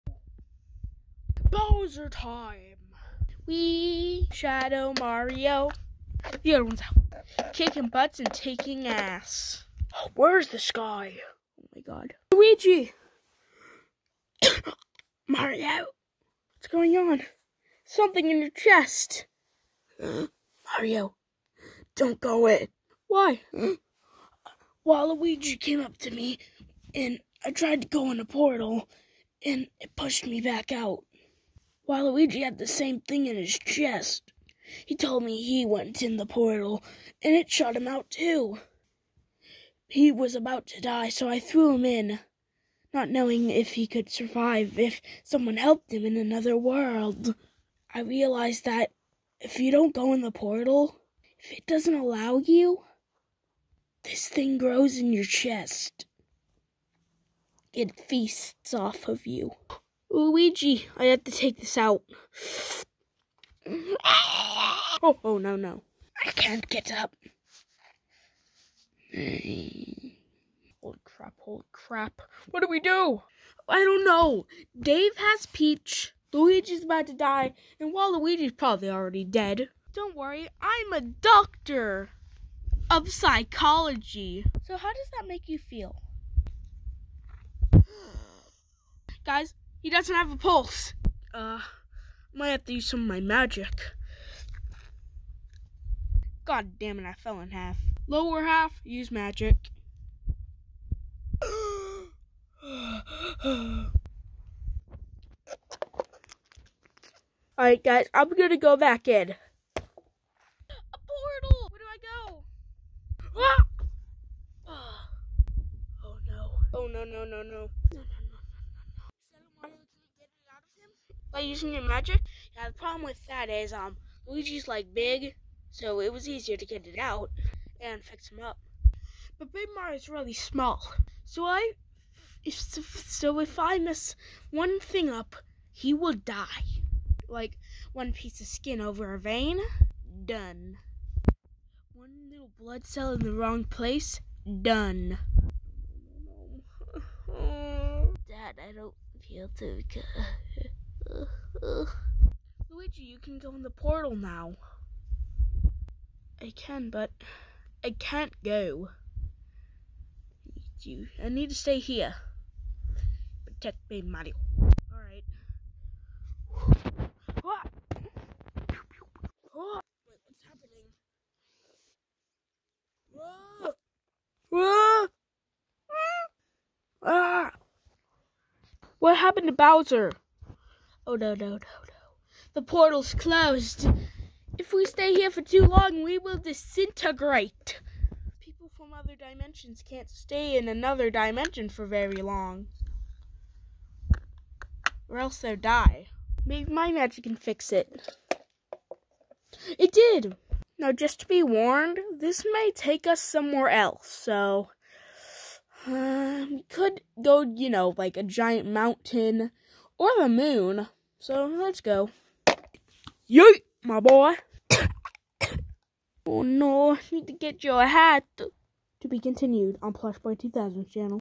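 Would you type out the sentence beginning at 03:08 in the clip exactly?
People from other dimensions can't stay in another dimension for very long.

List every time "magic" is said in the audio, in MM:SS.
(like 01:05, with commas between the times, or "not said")
01:33, 01:39, 02:01, 03:16.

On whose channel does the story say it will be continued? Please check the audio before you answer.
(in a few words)
Plush Boy 2000.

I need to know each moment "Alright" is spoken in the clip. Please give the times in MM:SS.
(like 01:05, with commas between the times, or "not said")
01:47, 02:44.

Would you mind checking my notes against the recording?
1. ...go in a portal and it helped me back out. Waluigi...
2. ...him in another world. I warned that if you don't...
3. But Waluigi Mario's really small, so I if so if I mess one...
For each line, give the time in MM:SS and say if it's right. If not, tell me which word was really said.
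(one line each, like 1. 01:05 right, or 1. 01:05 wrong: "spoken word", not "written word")
1. 00:27 wrong: "pushed", not "helped"
2. 00:45 wrong: "realized", not "warned"
3. 02:09 wrong: "Big", not "Waluigi".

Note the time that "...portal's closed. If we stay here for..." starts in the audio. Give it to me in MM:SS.
03:02.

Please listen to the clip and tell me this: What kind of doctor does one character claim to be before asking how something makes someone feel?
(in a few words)
psychology.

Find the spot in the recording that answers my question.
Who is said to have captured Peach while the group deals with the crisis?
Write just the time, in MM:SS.
01:14.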